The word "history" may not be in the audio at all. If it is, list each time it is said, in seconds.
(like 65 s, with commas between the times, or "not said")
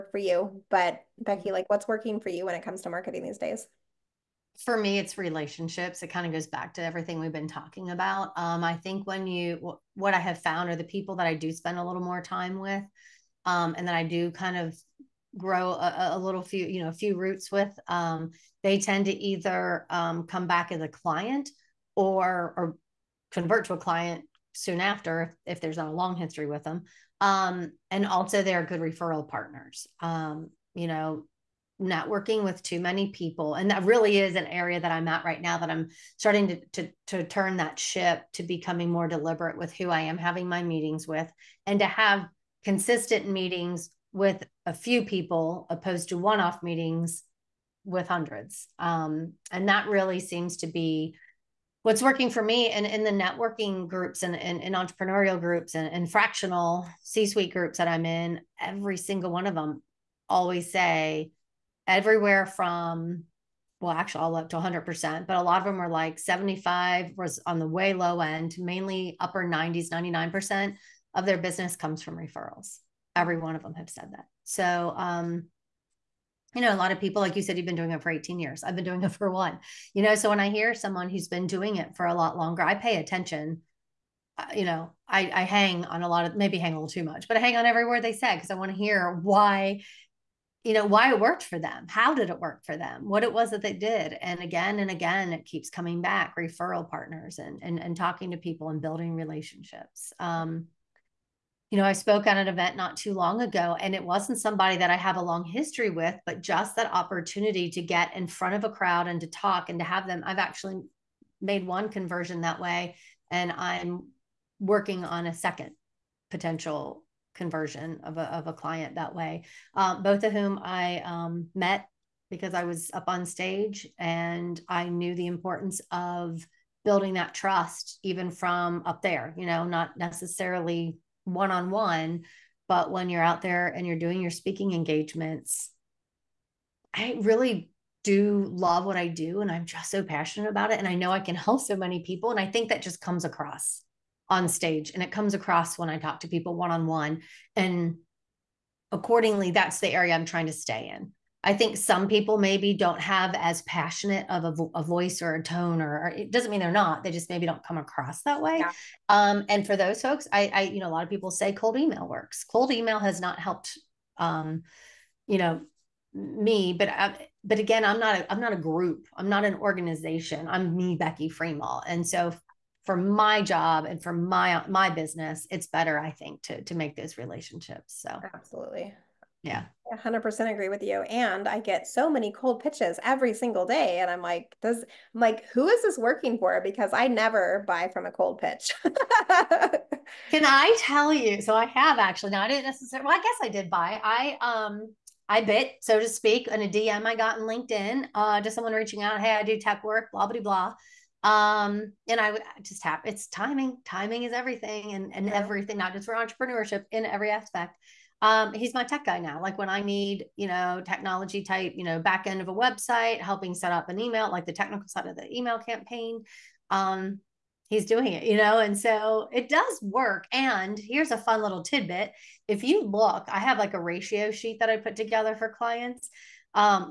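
26 s, 105 s.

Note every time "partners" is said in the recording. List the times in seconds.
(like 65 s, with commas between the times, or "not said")
29 s, 96 s.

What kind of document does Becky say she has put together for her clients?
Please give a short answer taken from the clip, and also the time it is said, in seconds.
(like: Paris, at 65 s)
Ratio sheet, at 223 s.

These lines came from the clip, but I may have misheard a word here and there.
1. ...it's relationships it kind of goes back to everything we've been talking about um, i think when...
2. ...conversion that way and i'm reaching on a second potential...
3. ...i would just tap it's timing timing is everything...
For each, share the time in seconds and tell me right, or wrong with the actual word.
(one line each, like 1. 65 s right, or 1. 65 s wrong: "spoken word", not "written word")
1. 4 s right
2. 111 s wrong: "working", not "reaching"
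3. 202 s right.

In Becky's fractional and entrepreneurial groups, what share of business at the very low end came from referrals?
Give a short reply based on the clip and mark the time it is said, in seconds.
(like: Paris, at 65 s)
75%, at 66 s.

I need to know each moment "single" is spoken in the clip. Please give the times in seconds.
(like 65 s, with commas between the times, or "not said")
58 s, 183 s.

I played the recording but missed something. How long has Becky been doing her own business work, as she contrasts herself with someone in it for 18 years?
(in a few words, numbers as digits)
1 year.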